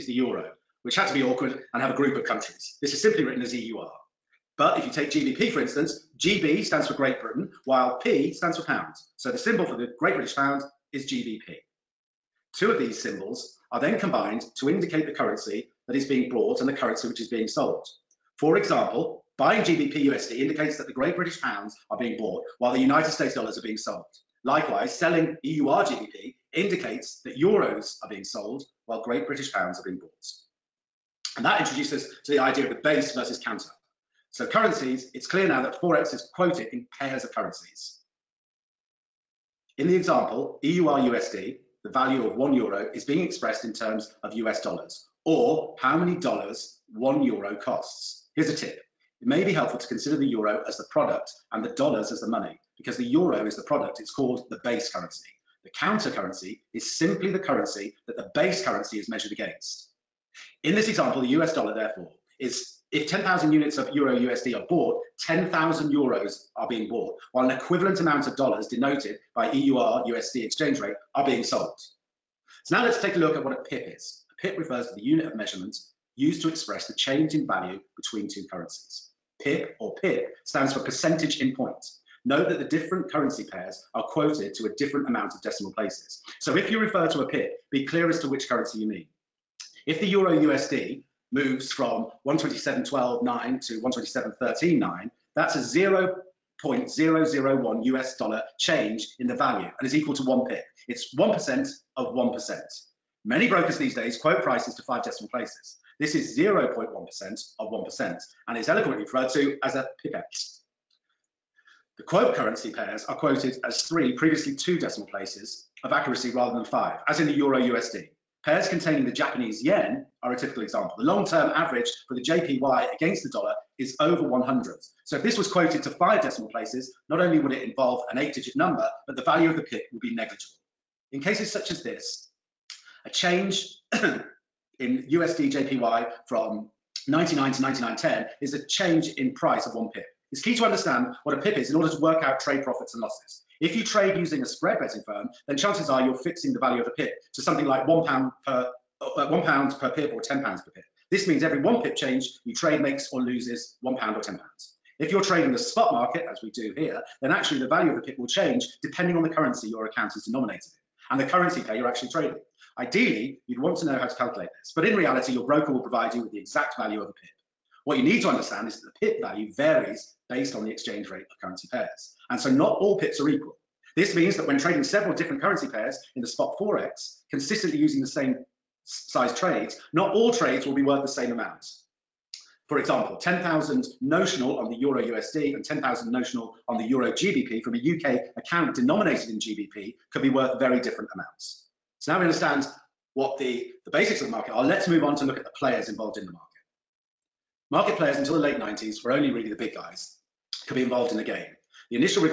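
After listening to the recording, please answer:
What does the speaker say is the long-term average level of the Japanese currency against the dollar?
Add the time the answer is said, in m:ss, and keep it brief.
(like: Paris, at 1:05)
over 100, at 2:03.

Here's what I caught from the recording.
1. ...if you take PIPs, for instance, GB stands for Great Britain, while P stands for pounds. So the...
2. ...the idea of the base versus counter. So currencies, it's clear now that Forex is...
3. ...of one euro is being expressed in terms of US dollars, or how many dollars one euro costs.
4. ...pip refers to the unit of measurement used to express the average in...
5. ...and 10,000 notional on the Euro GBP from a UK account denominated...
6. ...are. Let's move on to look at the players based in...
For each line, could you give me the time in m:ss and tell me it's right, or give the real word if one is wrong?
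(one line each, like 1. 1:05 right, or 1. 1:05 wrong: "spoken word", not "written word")
1. 0:04 wrong: "GBP", not "PIPs"
2. 0:32 right
3. 0:42 right
4. 1:14 wrong: "change", not "average"
5. 3:05 right
6. 3:14 wrong: "involved", not "based".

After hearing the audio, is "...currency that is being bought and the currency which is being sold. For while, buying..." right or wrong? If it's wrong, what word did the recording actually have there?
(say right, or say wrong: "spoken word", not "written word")
wrong: "example", not "while".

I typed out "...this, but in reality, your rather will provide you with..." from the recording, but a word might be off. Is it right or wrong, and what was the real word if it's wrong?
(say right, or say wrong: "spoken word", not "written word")
wrong: "broker", not "rather".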